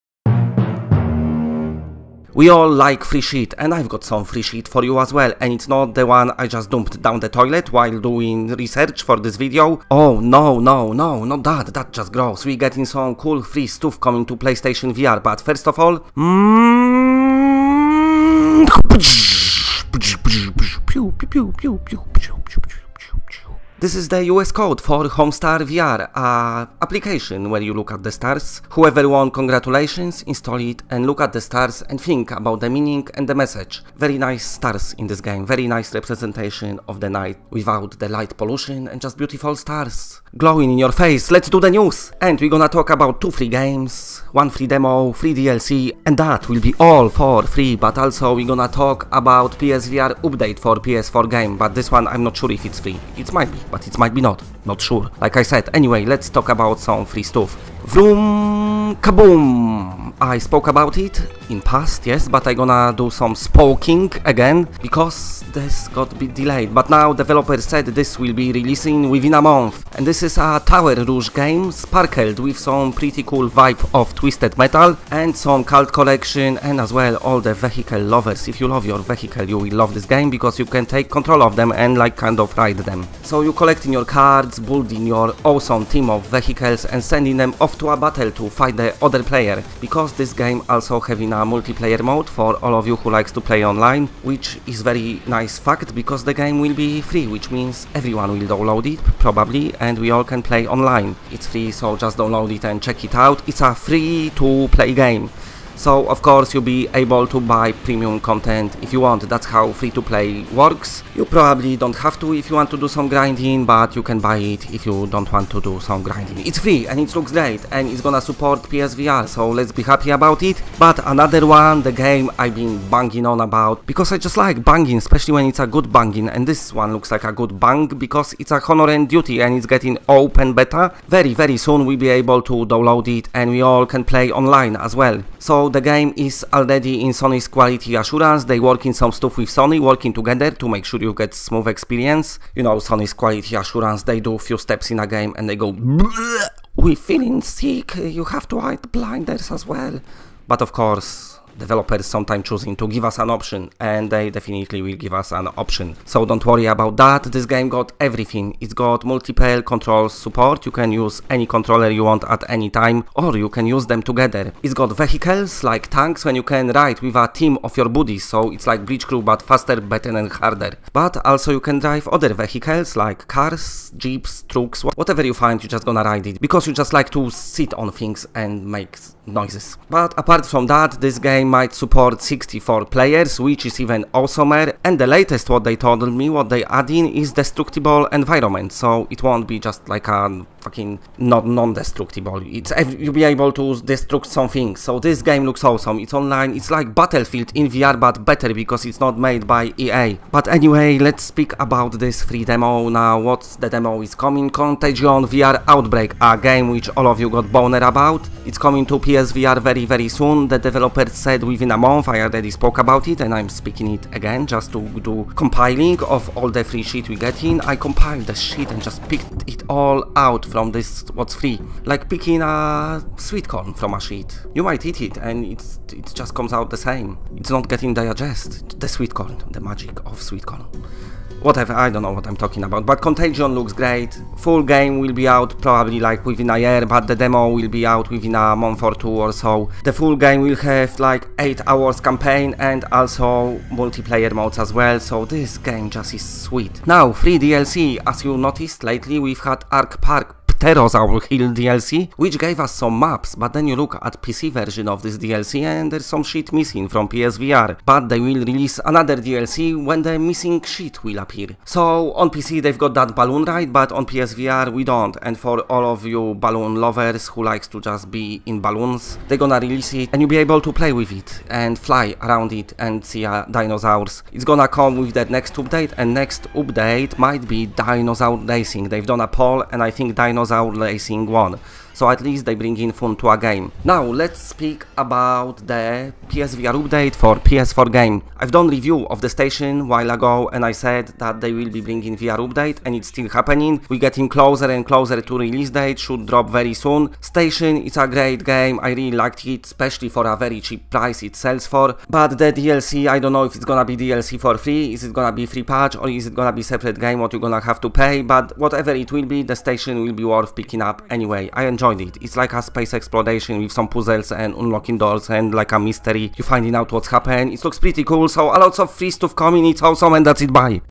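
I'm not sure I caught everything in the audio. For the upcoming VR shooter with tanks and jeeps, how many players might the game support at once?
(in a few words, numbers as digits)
64.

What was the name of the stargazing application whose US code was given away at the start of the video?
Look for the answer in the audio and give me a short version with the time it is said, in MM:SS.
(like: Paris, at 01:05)
Homestar VR, at 00:25.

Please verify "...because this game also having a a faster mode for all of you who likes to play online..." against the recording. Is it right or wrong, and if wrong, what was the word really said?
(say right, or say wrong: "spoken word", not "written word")
wrong: "multiplayer", not "faster".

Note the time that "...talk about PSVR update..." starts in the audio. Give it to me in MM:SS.
00:48.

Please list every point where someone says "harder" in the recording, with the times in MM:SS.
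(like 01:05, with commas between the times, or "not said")
02:50.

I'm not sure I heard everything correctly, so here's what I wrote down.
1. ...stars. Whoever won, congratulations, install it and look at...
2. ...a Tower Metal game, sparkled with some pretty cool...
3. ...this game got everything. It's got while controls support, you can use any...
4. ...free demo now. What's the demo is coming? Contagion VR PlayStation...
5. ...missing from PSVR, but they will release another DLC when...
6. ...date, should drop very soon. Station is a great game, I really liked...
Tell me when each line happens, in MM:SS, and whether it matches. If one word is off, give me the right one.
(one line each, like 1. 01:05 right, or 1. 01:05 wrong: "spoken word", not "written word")
1. 00:28 right
2. 01:10 wrong: "Rouge", not "Metal"
3. 02:37 wrong: "multiple", not "while"
4. 03:22 wrong: "Outbreak", not "PlayStation"
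5. 04:16 right
6. 04:55 right.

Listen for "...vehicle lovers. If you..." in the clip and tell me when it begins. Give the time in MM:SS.
01:17.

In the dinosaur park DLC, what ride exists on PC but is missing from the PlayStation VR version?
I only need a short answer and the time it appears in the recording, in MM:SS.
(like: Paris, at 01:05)
balloon ride, at 04:23.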